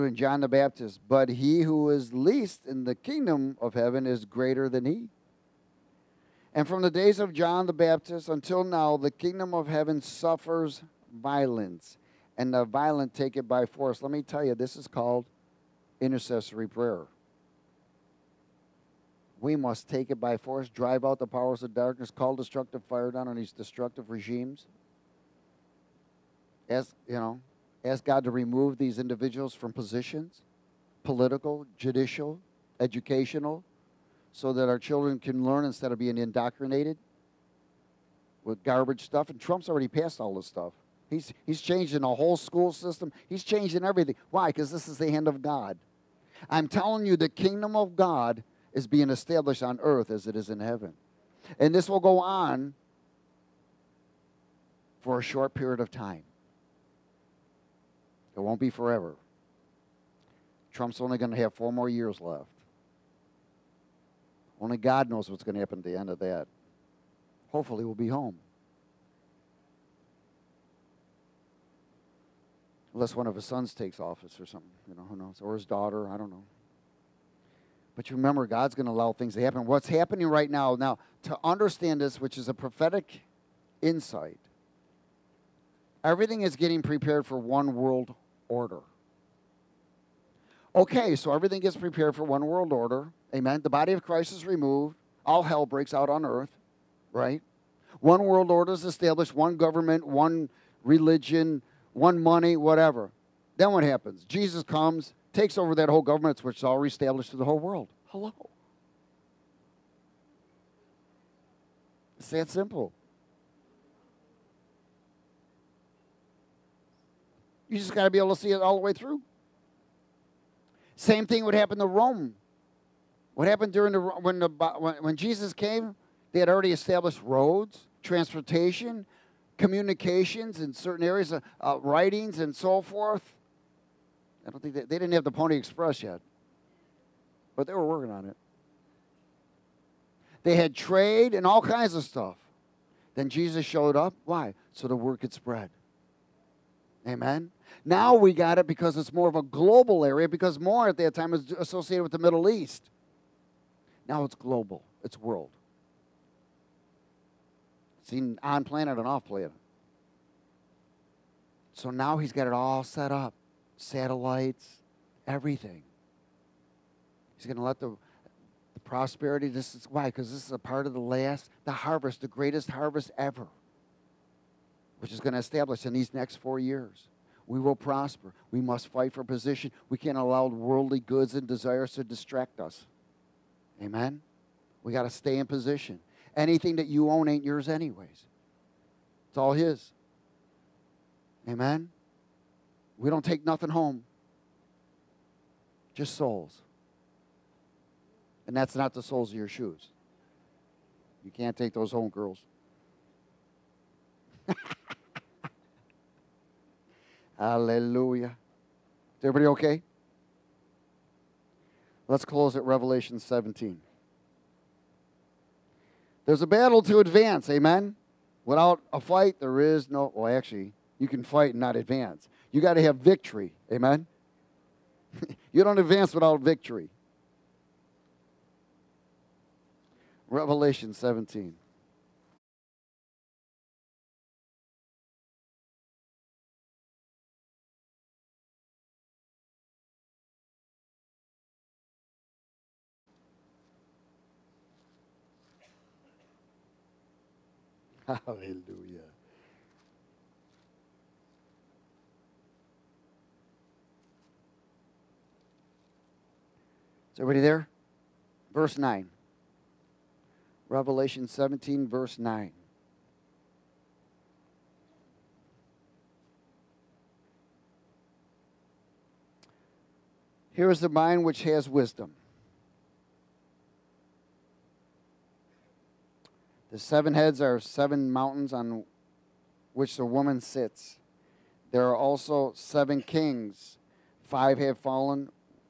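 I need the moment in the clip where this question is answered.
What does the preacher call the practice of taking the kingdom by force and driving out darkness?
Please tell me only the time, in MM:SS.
00:15.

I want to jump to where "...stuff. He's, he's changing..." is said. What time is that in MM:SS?
00:40.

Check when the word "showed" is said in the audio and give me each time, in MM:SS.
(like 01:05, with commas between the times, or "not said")
02:23.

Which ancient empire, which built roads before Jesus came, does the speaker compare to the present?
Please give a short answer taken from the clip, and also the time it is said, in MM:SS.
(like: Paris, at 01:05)
Rome, at 02:01.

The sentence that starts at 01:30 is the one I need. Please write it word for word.
Okay, so everything gets prepared for one world order.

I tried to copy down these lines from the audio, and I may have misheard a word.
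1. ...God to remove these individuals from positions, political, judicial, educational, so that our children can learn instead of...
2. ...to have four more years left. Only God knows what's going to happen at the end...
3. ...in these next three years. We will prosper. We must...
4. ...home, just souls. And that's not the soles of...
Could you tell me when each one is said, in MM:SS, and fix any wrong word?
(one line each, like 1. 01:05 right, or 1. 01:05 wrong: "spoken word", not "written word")
1. 00:28 right
2. 01:01 right
3. 02:55 wrong: "four", not "three"
4. 03:13 right.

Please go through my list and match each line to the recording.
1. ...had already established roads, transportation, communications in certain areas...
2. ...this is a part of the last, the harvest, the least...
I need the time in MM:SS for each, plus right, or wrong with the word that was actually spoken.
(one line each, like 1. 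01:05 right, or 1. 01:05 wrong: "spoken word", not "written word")
1. 02:06 right
2. 02:50 wrong: "greatest", not "least".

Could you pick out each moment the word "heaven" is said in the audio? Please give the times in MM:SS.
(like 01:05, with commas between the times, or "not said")
00:03, 00:09, 00:50.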